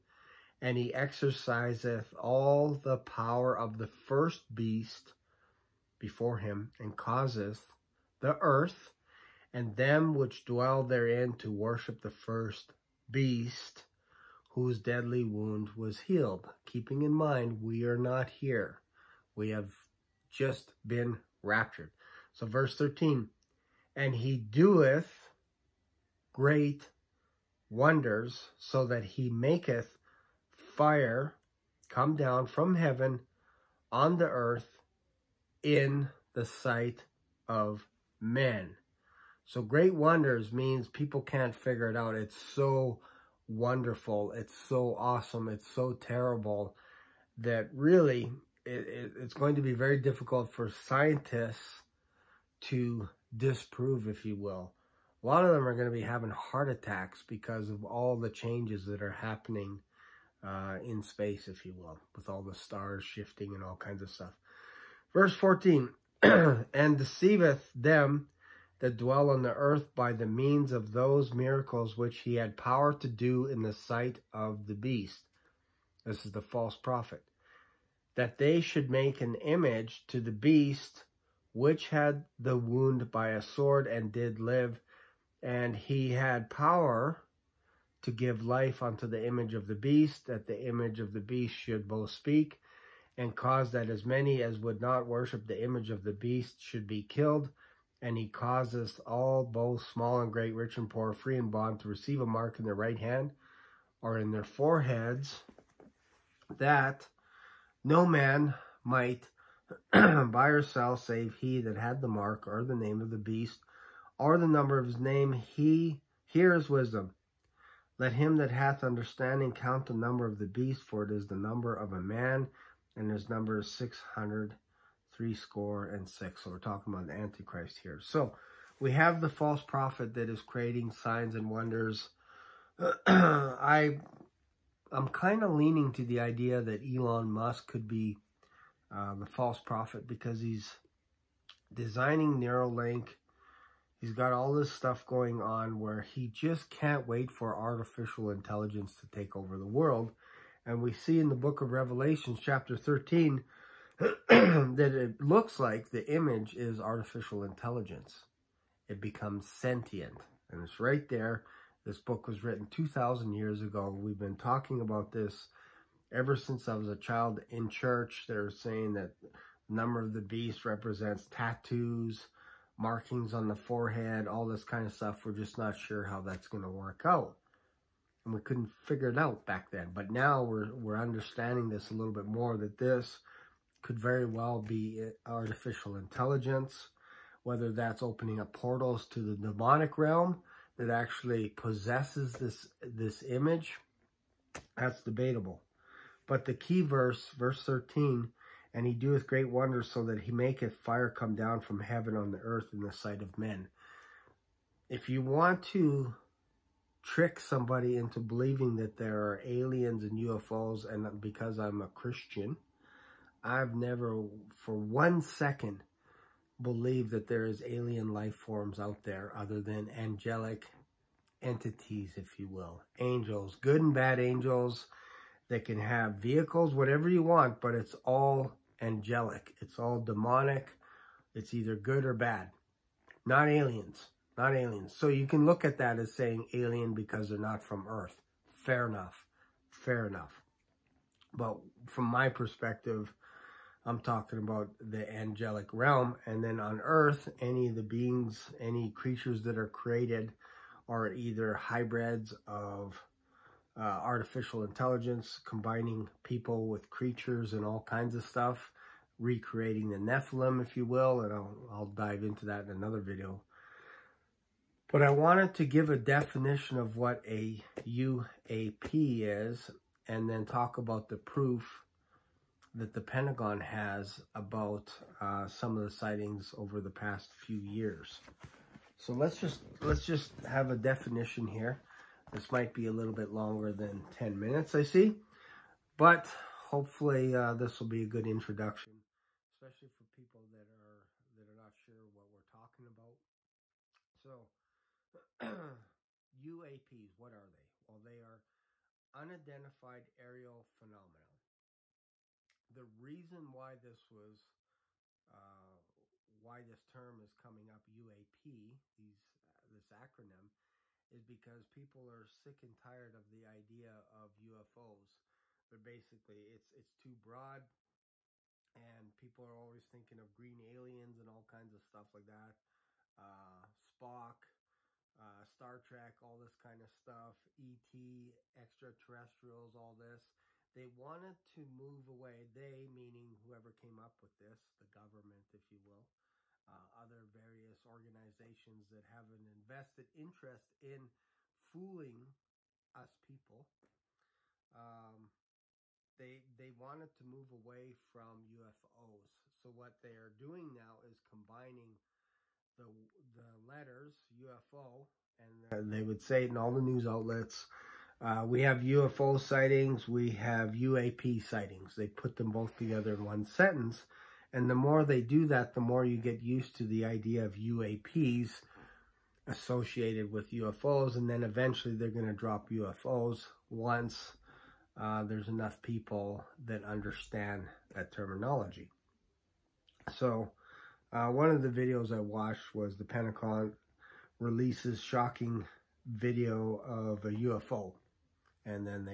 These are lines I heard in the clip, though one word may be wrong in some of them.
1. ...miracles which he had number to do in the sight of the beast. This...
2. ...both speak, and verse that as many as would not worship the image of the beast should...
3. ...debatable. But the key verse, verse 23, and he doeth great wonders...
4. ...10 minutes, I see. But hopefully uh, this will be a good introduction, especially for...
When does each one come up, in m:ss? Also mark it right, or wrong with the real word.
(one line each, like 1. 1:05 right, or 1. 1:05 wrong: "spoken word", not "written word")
1. 1:11 wrong: "power", not "number"
2. 1:31 wrong: "cause", not "verse"
3. 3:15 wrong: "13", not "23"
4. 4:44 right.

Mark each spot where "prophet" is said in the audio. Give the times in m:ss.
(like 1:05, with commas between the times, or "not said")
1:16, 2:09, 2:19.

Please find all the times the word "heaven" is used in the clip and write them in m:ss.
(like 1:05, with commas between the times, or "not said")
0:32, 3:21.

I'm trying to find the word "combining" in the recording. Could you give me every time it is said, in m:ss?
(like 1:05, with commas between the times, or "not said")
4:15, 5:51.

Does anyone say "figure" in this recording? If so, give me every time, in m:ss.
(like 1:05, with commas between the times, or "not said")
0:41, 2:58.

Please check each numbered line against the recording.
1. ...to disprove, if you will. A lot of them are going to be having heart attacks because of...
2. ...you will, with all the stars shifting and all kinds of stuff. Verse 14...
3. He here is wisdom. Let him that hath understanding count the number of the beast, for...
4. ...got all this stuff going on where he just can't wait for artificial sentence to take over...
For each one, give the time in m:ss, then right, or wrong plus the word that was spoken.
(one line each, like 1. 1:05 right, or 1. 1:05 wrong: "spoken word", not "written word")
1. 0:52 right
2. 1:01 right
3. 1:55 right
4. 2:24 wrong: "intelligence", not "sentence".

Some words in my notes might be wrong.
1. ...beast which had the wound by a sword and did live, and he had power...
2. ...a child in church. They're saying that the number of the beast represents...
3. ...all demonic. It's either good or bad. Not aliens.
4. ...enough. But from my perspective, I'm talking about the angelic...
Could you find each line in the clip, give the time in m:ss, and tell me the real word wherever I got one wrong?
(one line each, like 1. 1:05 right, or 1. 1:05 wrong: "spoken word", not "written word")
1. 1:20 right
2. 2:46 right
3. 3:49 right
4. 4:00 right.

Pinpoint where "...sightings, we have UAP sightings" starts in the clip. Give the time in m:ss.
5:59.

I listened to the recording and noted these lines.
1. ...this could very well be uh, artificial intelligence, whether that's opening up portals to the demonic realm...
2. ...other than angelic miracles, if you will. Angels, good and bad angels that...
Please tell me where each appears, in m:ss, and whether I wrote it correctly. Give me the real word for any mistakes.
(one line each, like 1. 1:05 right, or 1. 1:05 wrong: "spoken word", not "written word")
1. 3:02 right
2. 3:39 wrong: "entities", not "miracles".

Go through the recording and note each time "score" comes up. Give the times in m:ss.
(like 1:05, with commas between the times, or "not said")
2:05.